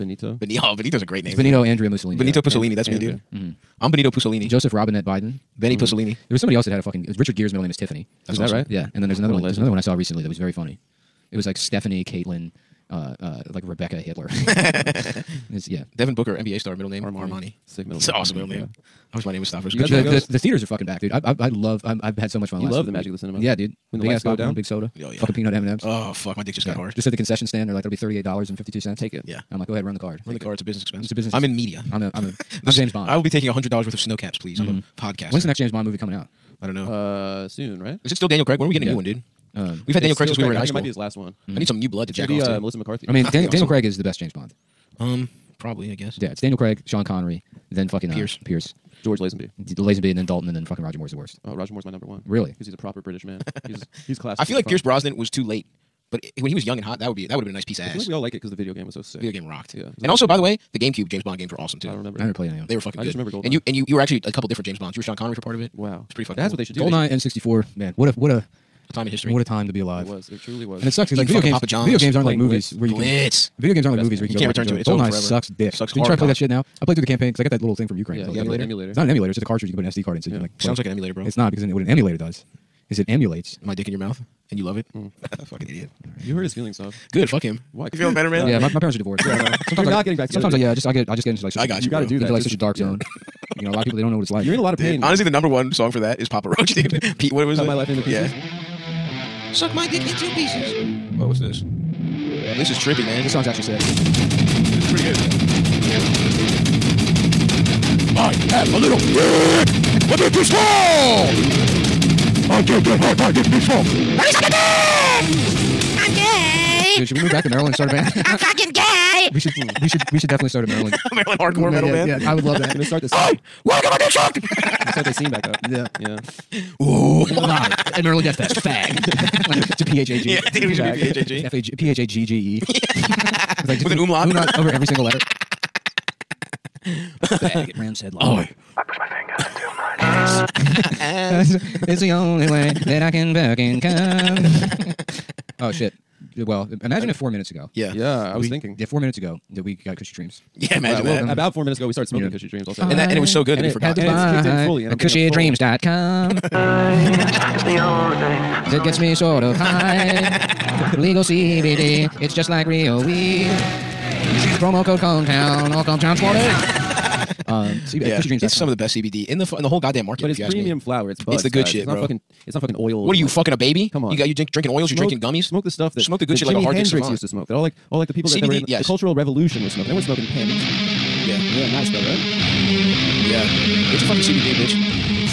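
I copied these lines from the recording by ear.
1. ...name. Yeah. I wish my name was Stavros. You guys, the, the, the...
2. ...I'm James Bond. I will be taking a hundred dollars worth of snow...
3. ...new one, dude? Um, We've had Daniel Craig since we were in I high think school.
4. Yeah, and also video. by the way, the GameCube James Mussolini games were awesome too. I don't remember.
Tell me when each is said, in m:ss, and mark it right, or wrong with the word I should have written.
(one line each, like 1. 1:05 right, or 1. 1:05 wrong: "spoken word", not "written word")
1. 0:18 right
2. 0:32 right
3. 0:38 right
4. 0:59 wrong: "Bond", not "Mussolini".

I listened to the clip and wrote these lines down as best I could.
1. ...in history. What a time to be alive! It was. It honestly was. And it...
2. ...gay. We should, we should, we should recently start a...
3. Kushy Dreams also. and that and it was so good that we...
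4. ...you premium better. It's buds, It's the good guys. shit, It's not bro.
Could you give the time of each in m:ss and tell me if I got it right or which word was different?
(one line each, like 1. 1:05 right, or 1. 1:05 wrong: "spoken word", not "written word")
1. 1:09 wrong: "truly", not "honestly"
2. 1:58 wrong: "definitely", not "recently"
3. 2:32 right
4. 2:50 wrong: "flower", not "better".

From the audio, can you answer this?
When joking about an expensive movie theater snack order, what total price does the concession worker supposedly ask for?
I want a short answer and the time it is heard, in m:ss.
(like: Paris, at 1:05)
$38.52, at 0:27.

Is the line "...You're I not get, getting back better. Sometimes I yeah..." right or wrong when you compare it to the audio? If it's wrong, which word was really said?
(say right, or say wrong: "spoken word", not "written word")
wrong: "together", not "better".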